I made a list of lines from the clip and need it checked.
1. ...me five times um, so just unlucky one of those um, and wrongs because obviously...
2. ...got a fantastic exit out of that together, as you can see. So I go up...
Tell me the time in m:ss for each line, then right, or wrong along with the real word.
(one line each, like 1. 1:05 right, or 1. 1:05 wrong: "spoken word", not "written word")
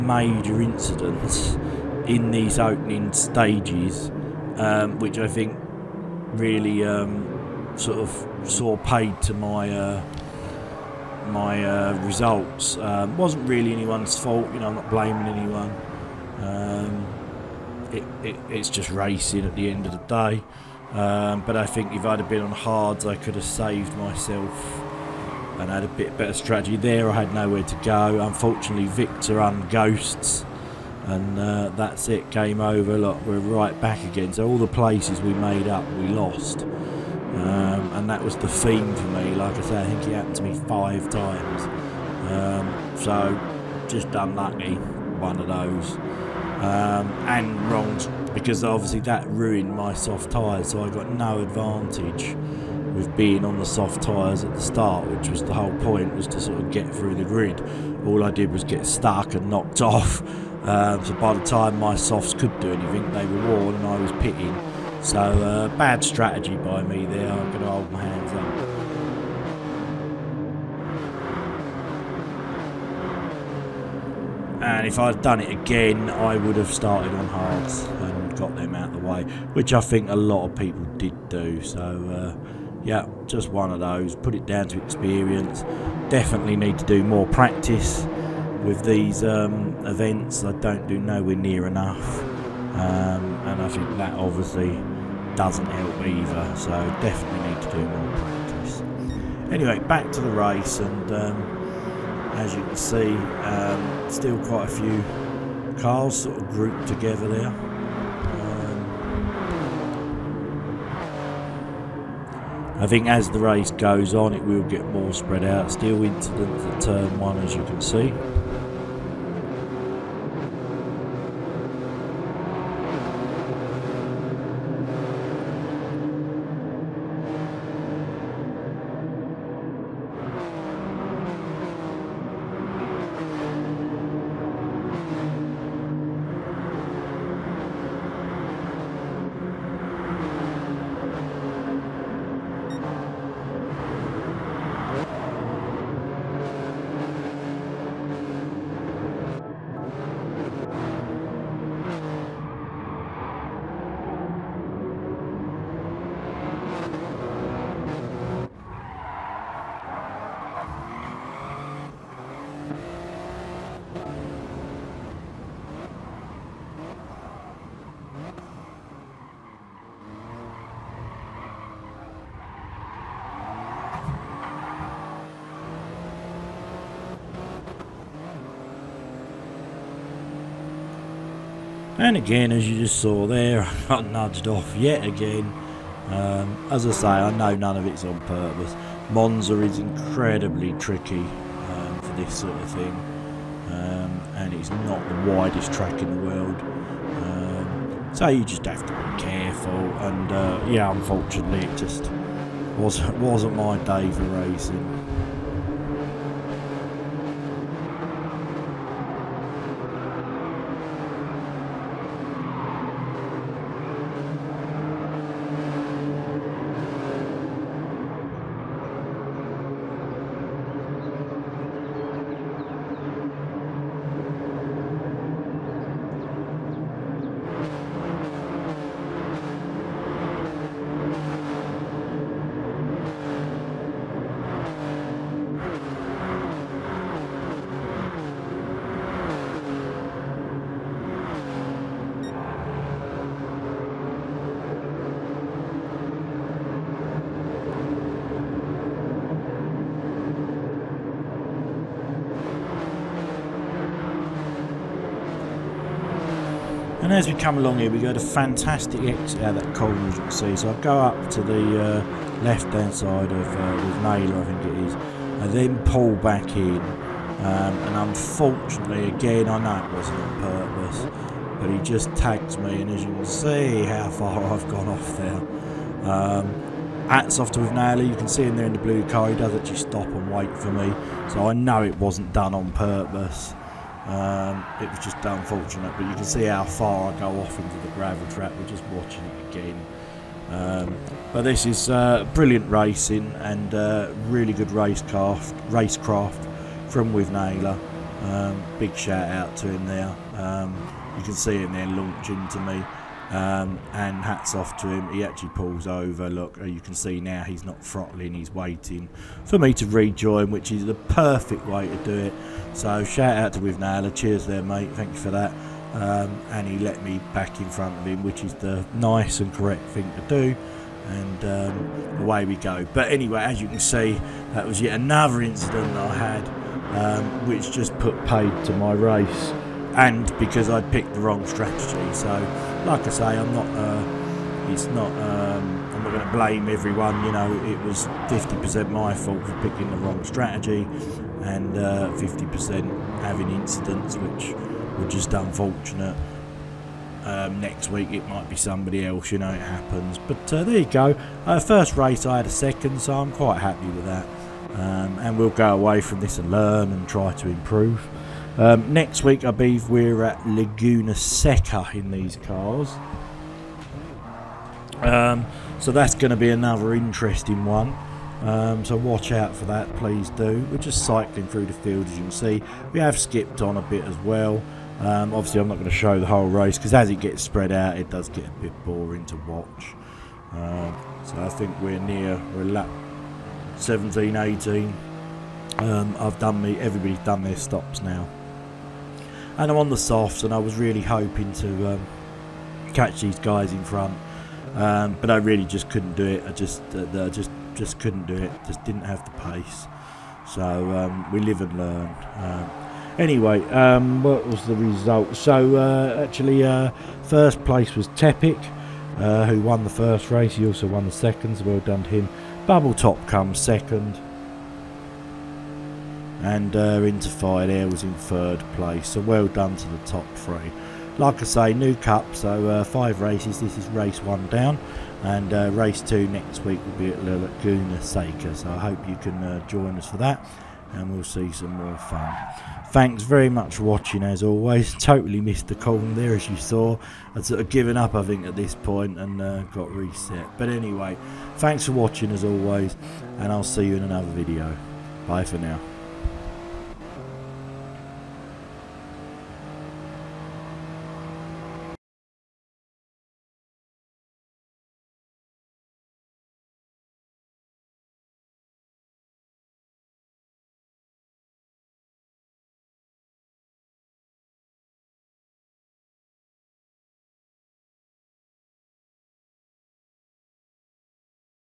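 1. 0:40 right
2. 4:17 wrong: "corner", not "together".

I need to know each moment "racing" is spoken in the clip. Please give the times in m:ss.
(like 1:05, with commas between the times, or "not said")
0:18, 3:24, 4:52.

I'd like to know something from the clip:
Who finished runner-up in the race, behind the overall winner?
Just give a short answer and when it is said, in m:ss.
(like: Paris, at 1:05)
Bubble Top, at 6:52.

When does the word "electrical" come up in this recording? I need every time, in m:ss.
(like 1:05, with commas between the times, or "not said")
not said.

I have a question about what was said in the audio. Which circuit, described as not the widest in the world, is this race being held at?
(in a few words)
Monza.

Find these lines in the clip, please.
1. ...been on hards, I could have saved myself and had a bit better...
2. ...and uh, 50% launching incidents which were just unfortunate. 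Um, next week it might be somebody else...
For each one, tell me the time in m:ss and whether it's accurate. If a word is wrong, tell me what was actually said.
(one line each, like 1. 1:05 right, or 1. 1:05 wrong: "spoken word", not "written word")
1. 0:22 right
2. 5:41 wrong: "having", not "launching".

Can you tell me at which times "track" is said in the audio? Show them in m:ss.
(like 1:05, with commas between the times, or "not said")
3:15.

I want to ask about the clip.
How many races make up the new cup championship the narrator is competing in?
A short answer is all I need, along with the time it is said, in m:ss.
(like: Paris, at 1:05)
5, at 7:02.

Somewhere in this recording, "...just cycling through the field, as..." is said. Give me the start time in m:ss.
6:10.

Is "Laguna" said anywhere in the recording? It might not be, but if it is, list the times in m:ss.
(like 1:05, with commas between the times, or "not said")
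6:00, 7:07.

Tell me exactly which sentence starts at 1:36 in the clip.
So definitely need to do more practice.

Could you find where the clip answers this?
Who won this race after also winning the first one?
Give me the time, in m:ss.
6:48.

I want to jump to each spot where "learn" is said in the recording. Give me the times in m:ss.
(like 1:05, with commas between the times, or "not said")
5:56, 6:41.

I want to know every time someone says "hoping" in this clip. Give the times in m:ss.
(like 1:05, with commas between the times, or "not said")
6:31.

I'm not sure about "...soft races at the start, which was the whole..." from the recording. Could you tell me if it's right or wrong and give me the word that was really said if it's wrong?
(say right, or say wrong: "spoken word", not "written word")
wrong: "tyres", not "races".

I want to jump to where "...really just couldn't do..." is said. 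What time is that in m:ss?
6:35.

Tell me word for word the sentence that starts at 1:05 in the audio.
So uh, bad strategy by me there.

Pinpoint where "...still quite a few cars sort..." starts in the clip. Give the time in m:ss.
1:44.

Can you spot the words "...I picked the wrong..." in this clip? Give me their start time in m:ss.
5:30.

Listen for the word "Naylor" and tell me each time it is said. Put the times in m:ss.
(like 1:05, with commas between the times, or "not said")
4:24, 4:37, 4:57, 5:13.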